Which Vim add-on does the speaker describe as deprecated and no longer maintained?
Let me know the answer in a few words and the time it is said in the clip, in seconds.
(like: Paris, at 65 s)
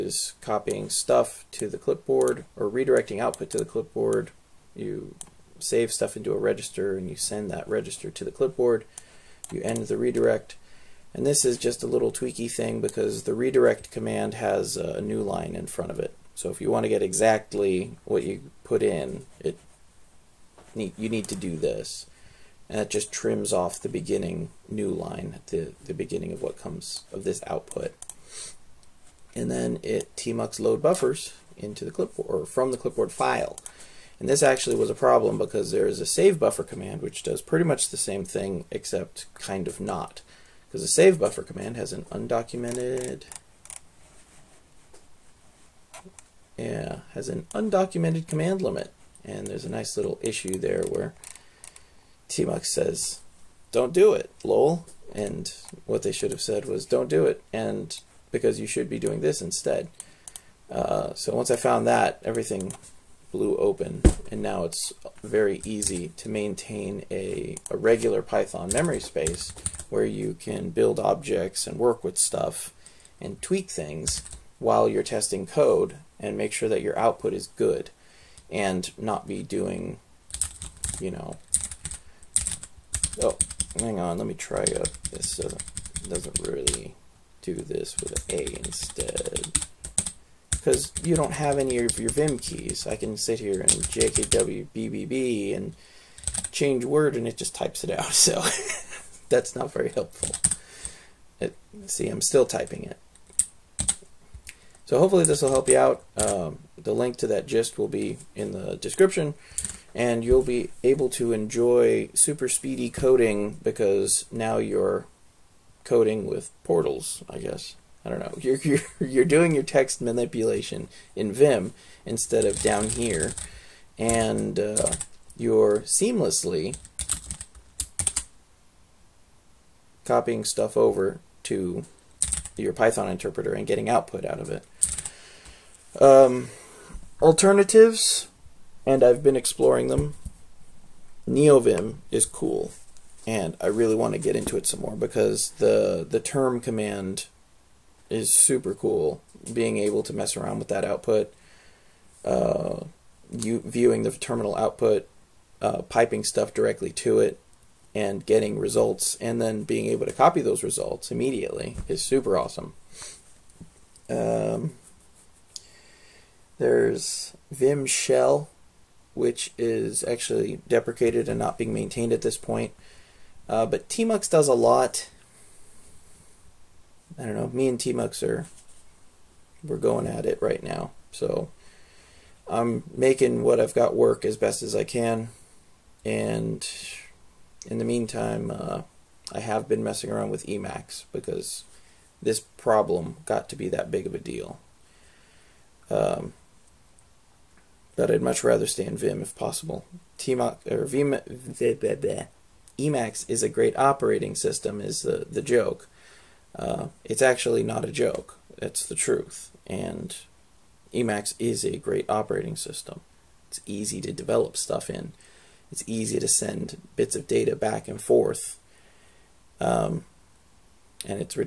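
Vim Shell, at 167 s.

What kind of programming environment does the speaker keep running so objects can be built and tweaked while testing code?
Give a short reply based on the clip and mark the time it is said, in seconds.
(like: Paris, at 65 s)
Python memory space, at 68 s.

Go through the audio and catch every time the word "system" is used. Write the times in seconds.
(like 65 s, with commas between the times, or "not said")
204 s, 212 s.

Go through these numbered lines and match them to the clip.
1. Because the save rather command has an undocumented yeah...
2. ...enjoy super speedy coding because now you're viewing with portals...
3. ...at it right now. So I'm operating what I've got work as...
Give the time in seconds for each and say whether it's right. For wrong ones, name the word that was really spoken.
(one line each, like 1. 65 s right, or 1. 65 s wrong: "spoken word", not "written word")
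1. 40 s wrong: "buffer", not "rather"
2. 111 s wrong: "coding", not "viewing"
3. 180 s wrong: "making", not "operating".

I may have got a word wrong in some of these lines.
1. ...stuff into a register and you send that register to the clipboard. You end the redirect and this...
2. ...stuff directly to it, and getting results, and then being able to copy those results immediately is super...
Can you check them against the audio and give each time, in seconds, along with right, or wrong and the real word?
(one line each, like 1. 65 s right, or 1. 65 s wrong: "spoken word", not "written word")
1. 5 s right
2. 156 s right.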